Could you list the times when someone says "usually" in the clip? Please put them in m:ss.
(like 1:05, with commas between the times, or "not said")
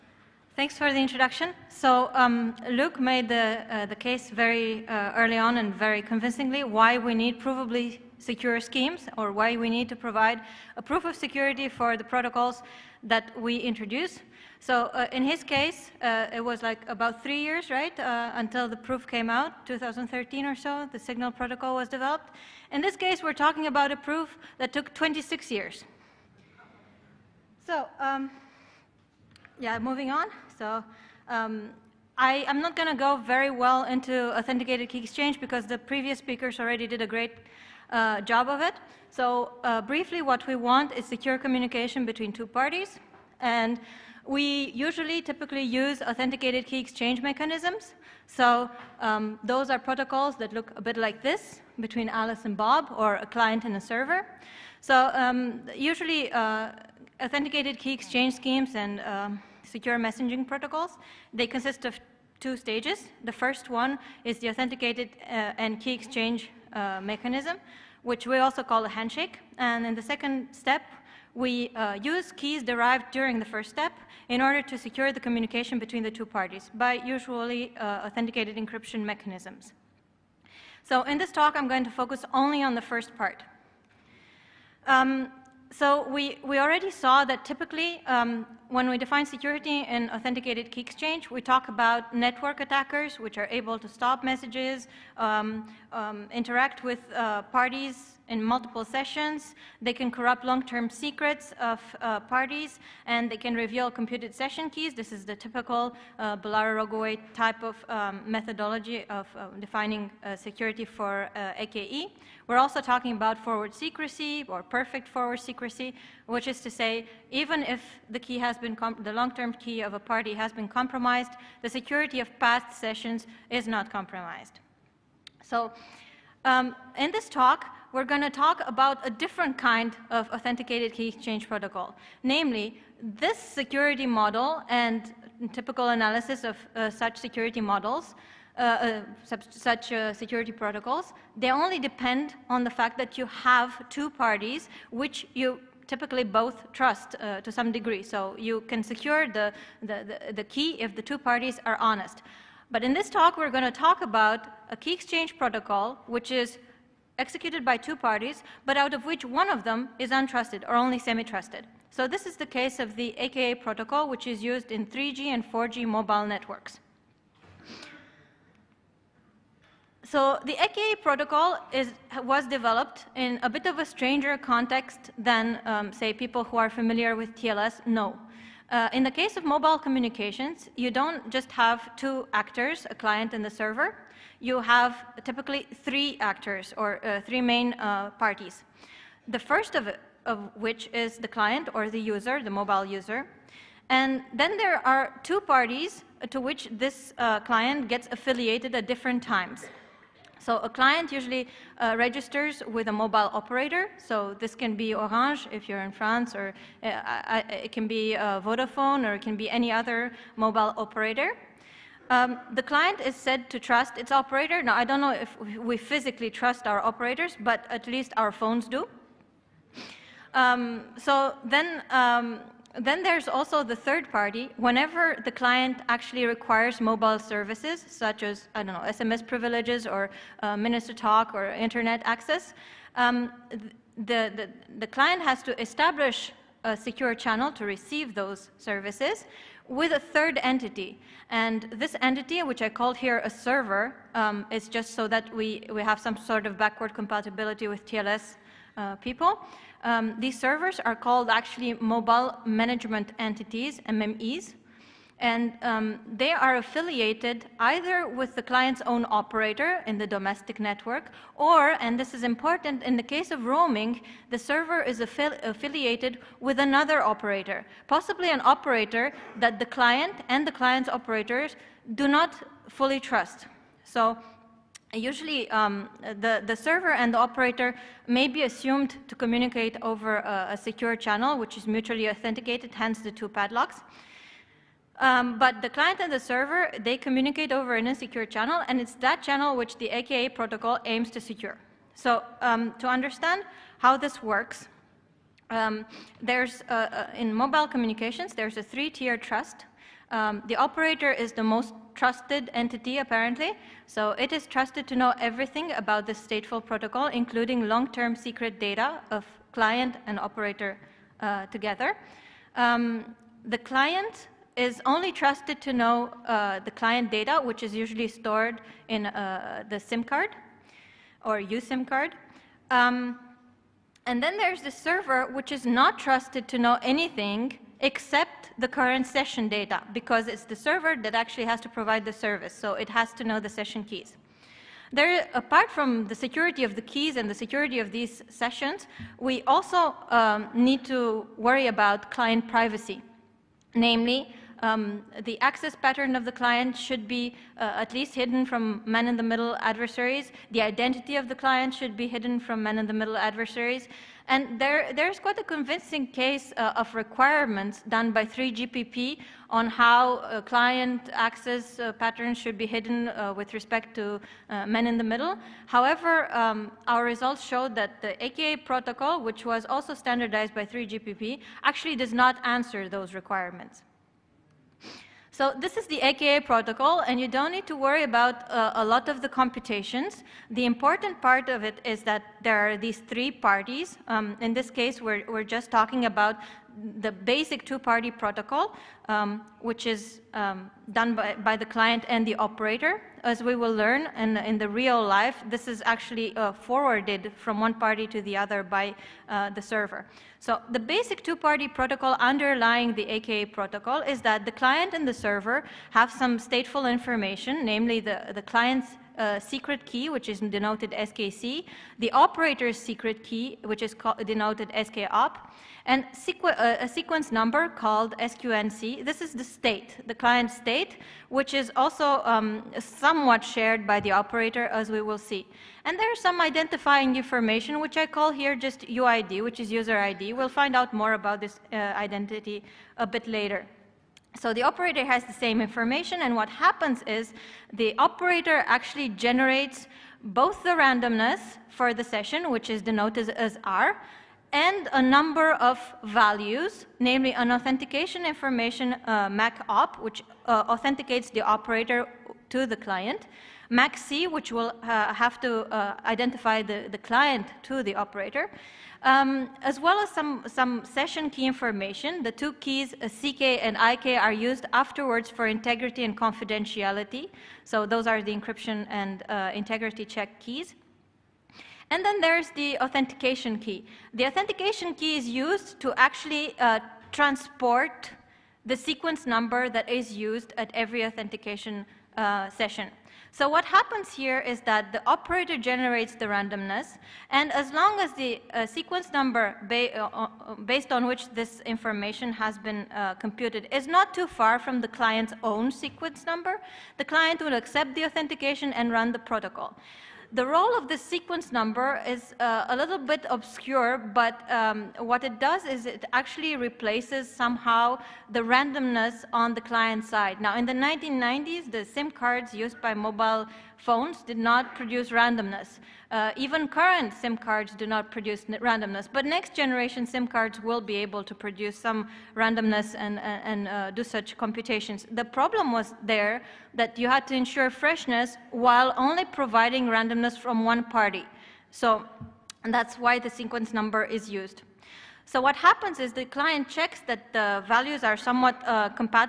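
0:44, 0:55, 1:16, 3:21, 4:34, 5:17.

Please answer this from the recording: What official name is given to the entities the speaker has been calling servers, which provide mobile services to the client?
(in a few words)
mobile management entities.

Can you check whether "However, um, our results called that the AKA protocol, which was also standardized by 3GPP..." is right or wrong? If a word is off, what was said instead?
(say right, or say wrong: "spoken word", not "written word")
wrong: "showed", not "called".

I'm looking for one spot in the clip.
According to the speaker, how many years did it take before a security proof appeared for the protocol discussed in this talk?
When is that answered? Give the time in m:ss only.
0:24.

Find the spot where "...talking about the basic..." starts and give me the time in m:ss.
6:25.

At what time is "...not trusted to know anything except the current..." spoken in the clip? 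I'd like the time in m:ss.
5:25.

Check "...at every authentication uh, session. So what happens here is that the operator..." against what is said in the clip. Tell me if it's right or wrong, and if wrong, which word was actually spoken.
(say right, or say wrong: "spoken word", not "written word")
right.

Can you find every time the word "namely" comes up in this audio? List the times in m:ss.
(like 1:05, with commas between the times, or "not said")
2:12, 5:43, 6:47, 7:26.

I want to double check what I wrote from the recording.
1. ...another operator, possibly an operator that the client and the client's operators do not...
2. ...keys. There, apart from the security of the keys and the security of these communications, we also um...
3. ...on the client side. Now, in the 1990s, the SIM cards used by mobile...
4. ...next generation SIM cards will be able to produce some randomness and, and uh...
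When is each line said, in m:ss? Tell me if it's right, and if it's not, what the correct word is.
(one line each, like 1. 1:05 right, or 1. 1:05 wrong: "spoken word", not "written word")
1. 4:26 right
2. 5:33 wrong: "sessions", not "communications"
3. 8:29 right
4. 8:39 right.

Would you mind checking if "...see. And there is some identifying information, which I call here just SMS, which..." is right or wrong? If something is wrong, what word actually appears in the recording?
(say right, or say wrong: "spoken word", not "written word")
wrong: "UID", not "SMS".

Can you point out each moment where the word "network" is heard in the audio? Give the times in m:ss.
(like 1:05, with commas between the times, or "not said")
1:32, 2:46, 4:20.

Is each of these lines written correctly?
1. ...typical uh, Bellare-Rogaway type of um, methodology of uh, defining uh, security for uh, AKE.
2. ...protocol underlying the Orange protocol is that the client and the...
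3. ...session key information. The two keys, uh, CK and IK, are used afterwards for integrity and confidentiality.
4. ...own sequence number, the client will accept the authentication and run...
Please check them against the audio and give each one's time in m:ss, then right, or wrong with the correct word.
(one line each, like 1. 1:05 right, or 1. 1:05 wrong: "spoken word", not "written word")
1. 1:45 right
2. 6:41 wrong: "AKA", not "Orange"
3. 7:40 right
4. 8:15 right.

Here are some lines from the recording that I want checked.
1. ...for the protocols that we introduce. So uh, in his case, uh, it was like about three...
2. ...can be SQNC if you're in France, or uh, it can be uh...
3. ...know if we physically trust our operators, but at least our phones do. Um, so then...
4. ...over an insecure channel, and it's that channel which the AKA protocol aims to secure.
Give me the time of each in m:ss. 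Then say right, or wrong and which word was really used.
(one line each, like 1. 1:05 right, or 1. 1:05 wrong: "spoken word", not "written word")
1. 0:11 right
2. 3:24 wrong: "Orange", not "SQNC"
3. 3:35 right
4. 4:47 right.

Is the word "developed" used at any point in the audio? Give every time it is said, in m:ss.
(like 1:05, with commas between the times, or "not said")
0:21, 2:52.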